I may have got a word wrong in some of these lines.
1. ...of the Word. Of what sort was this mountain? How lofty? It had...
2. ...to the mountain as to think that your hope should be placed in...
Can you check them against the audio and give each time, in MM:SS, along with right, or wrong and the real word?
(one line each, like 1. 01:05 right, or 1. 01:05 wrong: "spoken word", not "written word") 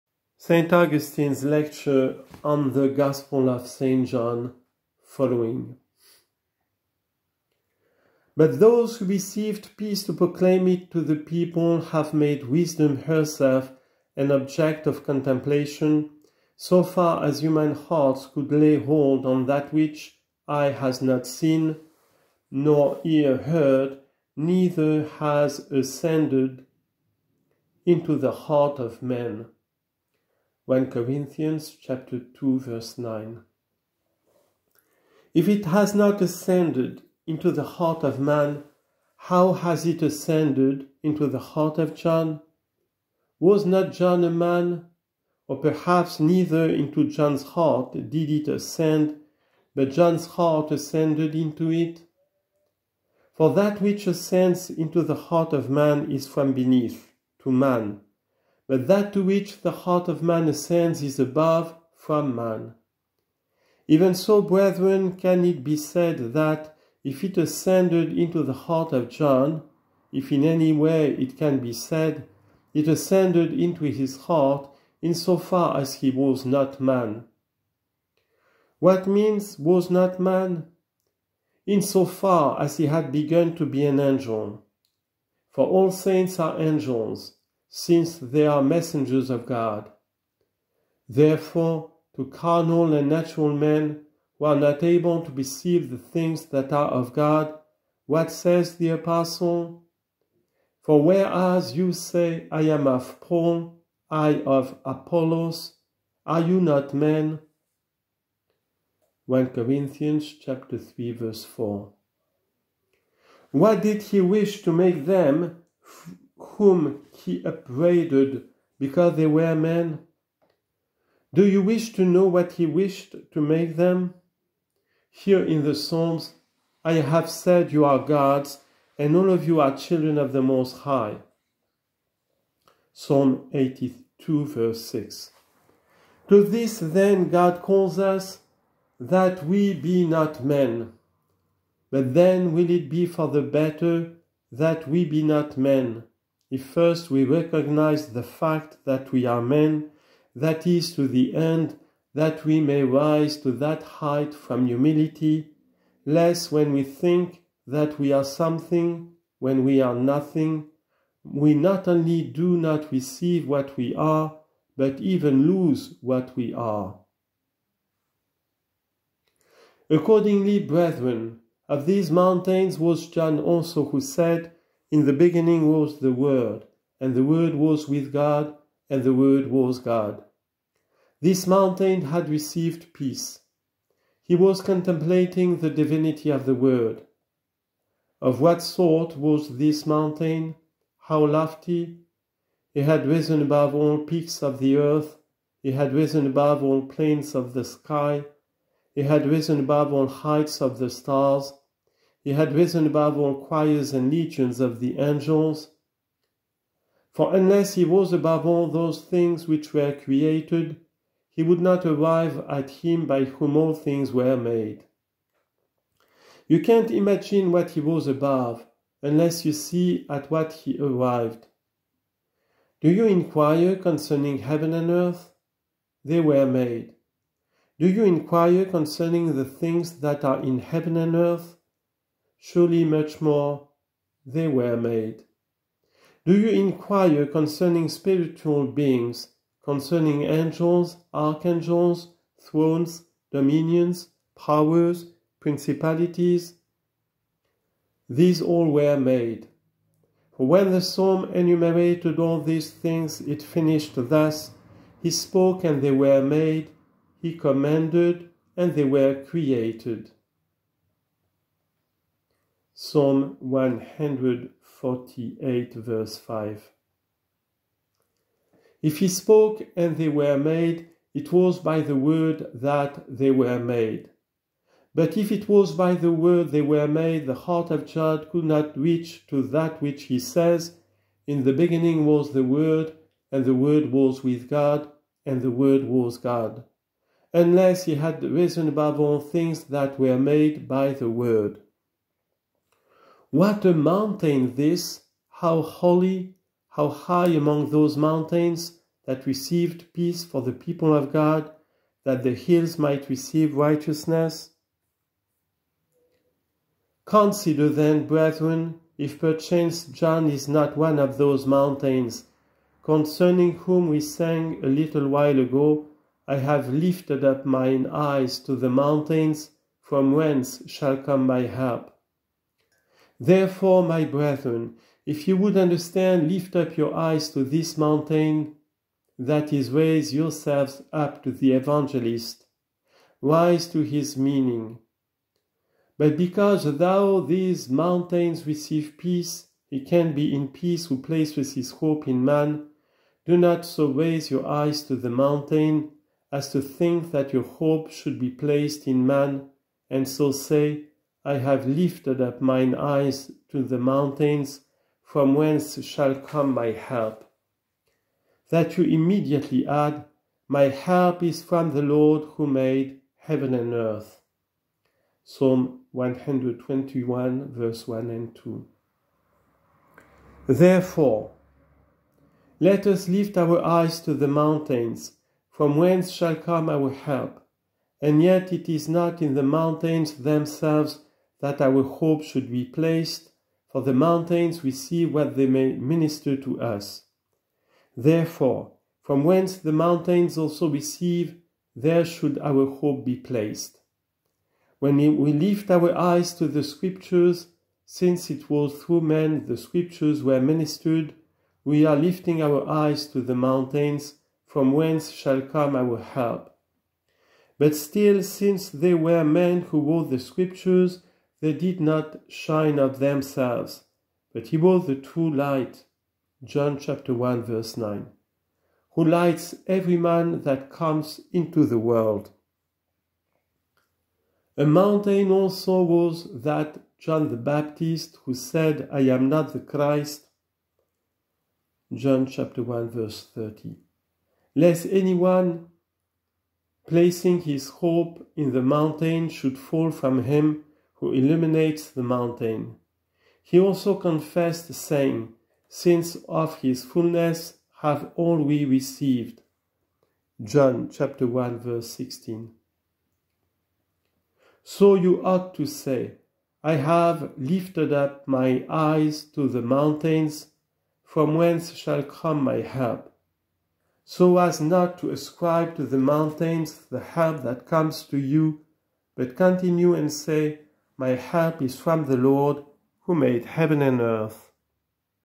1. 03:06 right
2. 05:44 right.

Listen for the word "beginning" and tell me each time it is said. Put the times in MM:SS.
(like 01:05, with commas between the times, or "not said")
02:55, 04:41.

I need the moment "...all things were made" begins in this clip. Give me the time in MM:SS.
03:33.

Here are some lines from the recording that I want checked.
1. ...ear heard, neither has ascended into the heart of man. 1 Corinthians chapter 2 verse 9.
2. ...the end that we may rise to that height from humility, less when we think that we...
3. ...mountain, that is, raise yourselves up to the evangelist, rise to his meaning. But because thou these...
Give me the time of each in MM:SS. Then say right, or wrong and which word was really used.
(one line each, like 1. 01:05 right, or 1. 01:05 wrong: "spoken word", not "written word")
1. 00:23 right
2. 02:31 right
3. 05:27 right.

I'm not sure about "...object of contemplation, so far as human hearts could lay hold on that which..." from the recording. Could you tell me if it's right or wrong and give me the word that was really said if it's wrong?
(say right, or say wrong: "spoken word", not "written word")
right.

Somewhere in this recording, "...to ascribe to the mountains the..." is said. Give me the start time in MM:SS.
07:44.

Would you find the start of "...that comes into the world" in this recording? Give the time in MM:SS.
07:00.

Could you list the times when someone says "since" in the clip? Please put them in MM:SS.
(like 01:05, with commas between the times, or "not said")
01:27, 06:37, 06:48, 07:25.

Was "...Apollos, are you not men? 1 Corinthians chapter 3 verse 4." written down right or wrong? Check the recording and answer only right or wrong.
right.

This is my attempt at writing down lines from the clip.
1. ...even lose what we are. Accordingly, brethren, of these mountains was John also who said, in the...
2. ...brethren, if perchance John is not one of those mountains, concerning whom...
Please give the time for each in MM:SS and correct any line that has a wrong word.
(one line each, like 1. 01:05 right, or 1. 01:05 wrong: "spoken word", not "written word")
1. 02:44 right
2. 05:08 right.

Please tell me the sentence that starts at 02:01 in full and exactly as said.
Do you wish to know what he wished to make them?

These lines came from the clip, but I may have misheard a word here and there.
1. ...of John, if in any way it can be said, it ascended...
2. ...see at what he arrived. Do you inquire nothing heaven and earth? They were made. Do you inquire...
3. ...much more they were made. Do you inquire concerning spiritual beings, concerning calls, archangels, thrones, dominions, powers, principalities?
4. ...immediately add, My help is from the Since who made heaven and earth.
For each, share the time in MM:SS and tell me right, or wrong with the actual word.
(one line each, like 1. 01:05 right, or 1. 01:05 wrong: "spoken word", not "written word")
1. 01:08 right
2. 03:39 wrong: "concerning", not "nothing"
3. 03:52 wrong: "angels", not "calls"
4. 05:58 wrong: "Lord", not "Since".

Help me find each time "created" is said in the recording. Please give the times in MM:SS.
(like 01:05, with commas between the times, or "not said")
03:29, 04:19.